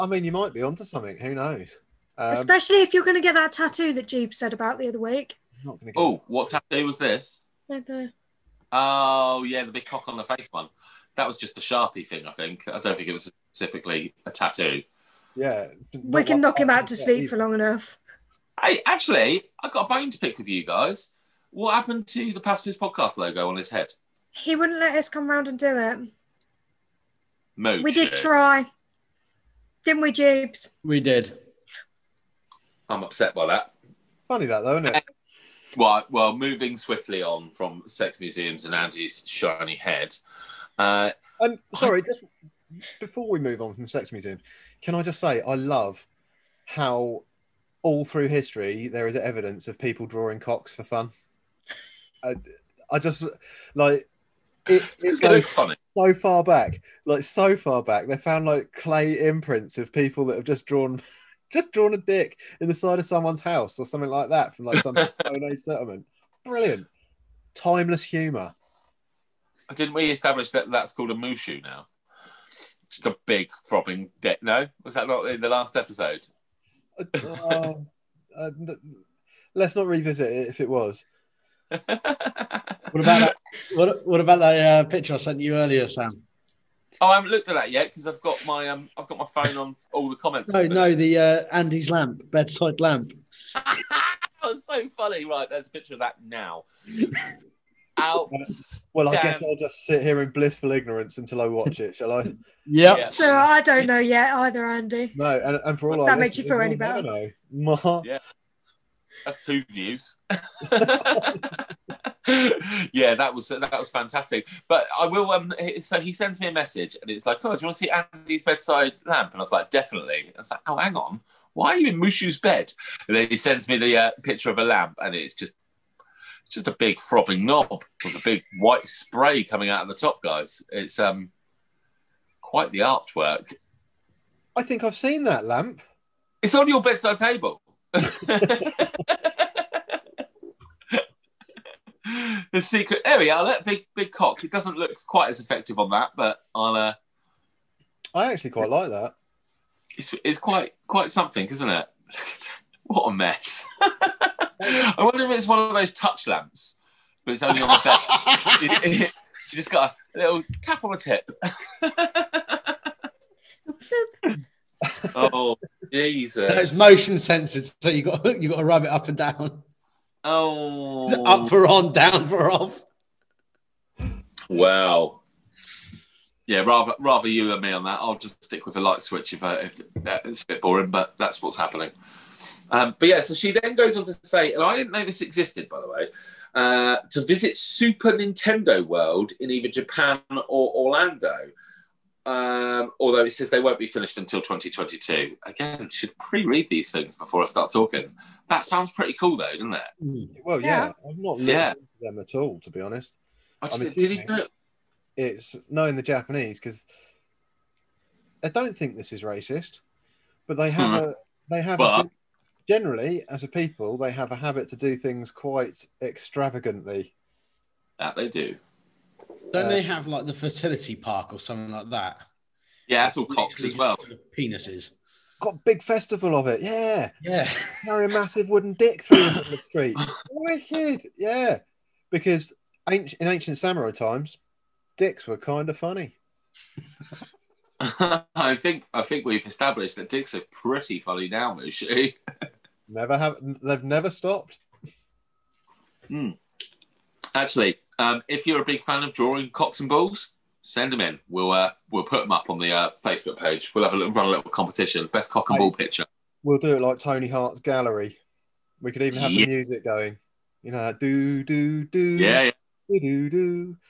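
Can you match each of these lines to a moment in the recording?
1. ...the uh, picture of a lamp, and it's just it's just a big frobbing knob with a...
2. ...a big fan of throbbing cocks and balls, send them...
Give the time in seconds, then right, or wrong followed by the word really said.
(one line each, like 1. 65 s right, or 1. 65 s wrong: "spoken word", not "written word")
1. 123 s right
2. 248 s wrong: "drawing", not "throbbing".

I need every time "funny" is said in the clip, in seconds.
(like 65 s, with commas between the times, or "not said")
34 s, 55 s, 94 s, 235 s, 240 s.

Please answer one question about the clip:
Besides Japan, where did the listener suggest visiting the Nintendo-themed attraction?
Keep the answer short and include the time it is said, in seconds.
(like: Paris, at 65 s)
Orlando, at 190 s.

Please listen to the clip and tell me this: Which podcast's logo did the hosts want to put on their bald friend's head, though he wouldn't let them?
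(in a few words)
Pacifist podcast.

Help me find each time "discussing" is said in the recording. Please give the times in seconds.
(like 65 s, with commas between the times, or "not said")
not said.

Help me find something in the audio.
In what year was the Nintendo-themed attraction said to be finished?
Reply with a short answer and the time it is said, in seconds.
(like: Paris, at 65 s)
2022, at 194 s.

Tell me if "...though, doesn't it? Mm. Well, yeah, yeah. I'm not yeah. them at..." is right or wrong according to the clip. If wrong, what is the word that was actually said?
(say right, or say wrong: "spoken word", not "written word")
right.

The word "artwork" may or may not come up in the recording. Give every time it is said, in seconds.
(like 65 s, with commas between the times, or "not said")
132 s.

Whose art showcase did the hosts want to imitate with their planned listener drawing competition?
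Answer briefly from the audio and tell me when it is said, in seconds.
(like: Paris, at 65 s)
Tony Hart's gallery, at 256 s.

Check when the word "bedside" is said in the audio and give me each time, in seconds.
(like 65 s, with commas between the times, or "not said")
92 s, 118 s, 136 s.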